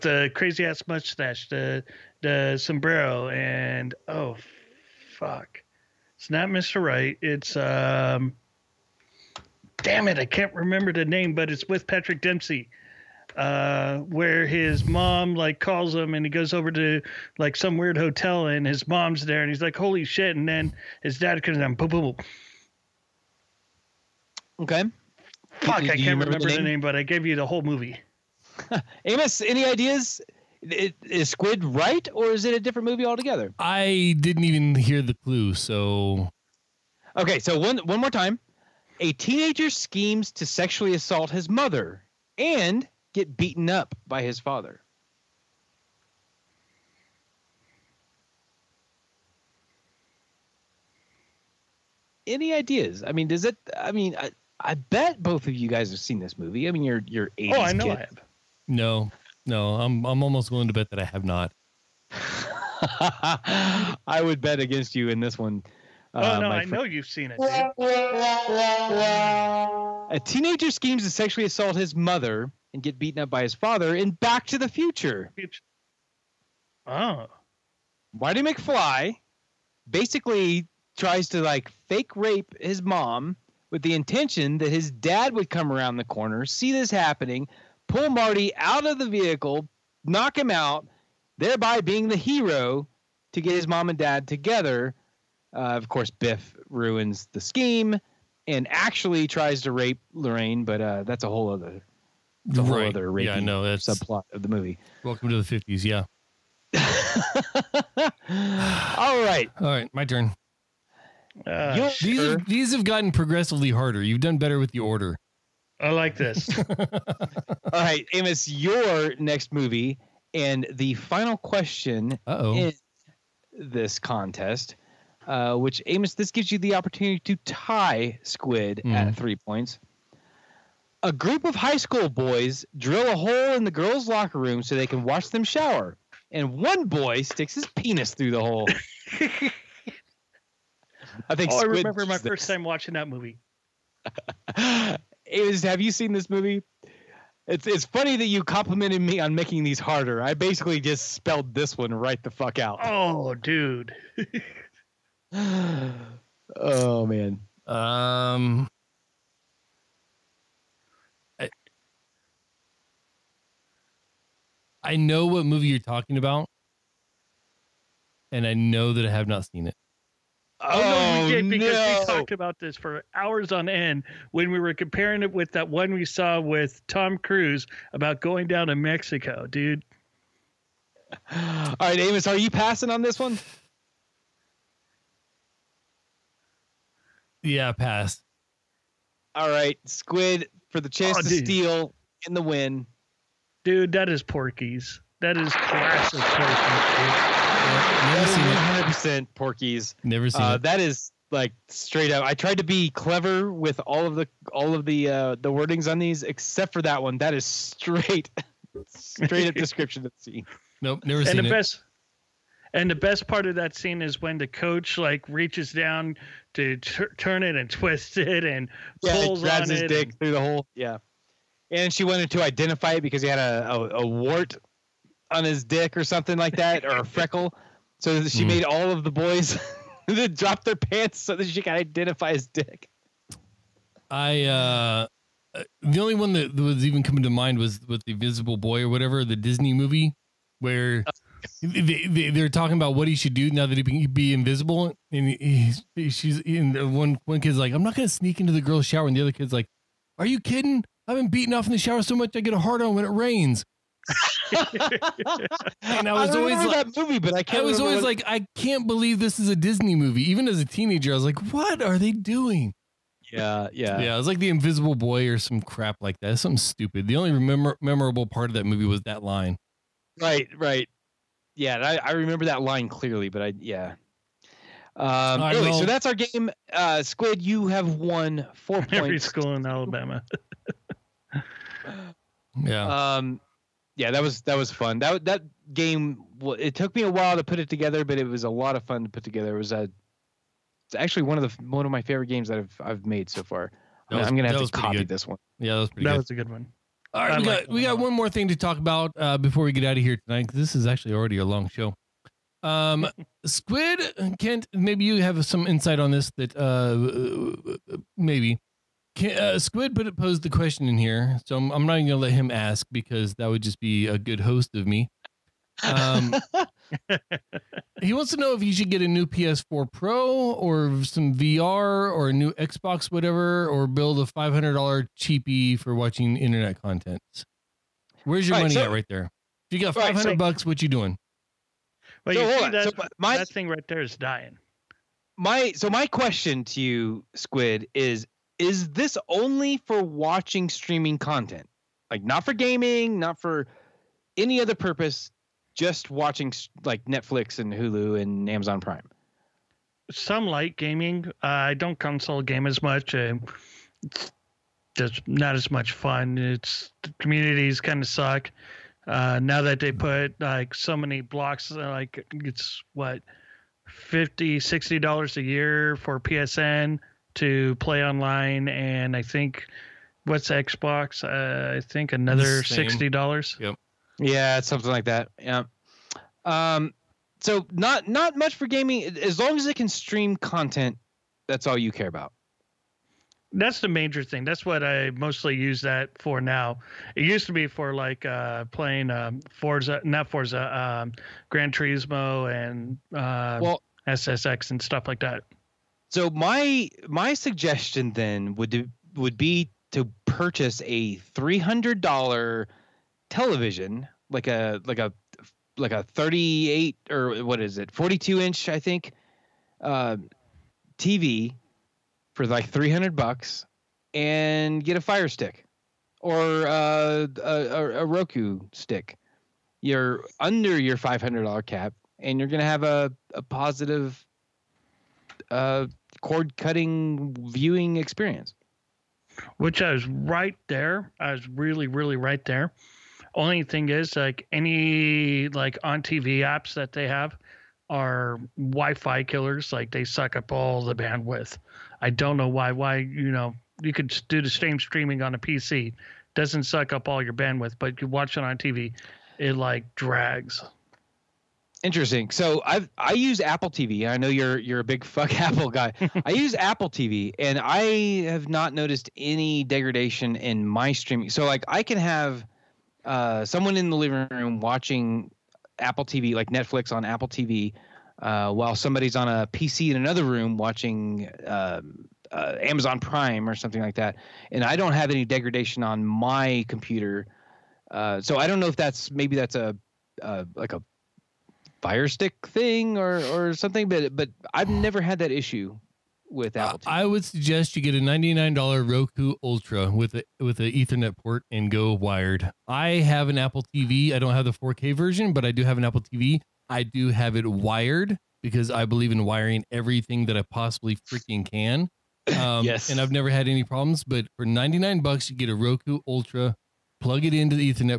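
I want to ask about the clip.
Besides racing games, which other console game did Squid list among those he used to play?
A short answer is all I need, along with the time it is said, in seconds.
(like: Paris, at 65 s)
SSX, at 394 s.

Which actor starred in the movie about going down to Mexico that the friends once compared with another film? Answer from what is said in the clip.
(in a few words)
Tom Cruise.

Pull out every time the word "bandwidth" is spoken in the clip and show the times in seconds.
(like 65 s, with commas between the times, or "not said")
440 s, 447 s.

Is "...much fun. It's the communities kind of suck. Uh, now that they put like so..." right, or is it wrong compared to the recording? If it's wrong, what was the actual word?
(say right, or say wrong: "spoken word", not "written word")
right.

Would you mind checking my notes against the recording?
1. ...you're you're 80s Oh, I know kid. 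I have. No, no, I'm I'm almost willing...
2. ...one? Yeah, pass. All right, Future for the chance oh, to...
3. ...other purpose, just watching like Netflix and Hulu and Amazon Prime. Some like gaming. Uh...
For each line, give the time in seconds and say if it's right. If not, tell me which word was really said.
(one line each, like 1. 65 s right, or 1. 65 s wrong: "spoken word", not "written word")
1. 56 s right
2. 183 s wrong: "Squid", not "Future"
3. 344 s right.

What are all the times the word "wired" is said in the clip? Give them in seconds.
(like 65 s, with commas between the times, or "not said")
491 s, 497 s.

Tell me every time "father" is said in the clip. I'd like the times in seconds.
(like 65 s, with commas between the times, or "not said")
44 s, 73 s.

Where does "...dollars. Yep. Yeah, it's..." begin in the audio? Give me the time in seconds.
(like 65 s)
373 s.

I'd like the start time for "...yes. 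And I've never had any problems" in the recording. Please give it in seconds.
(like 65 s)
502 s.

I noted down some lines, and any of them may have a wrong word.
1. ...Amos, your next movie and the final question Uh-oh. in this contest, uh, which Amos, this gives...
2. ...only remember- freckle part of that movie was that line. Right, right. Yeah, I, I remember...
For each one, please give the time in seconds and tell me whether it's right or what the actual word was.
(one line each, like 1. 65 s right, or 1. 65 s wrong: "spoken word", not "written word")
1. 118 s right
2. 267 s wrong: "memorable", not "freckle".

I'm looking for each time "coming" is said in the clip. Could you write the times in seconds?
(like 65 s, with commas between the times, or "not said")
237 s.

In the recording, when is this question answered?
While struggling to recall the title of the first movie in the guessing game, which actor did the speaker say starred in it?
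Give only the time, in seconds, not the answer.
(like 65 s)
11 s.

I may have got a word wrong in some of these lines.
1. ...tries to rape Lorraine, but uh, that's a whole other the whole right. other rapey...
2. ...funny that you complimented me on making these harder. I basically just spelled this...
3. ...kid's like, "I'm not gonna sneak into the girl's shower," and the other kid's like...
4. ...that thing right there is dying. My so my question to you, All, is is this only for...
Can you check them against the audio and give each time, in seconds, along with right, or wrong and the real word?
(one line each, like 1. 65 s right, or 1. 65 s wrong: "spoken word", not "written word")
1. 99 s right
2. 147 s right
3. 247 s right
4. 333 s wrong: "Squid", not "All".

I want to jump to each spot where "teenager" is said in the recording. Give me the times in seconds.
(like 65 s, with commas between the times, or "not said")
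39 s, 70 s, 260 s.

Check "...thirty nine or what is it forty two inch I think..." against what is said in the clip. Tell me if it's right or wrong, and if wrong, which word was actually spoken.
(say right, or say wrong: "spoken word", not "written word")
wrong: "eight", not "nine".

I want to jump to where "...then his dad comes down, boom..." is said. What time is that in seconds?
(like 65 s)
20 s.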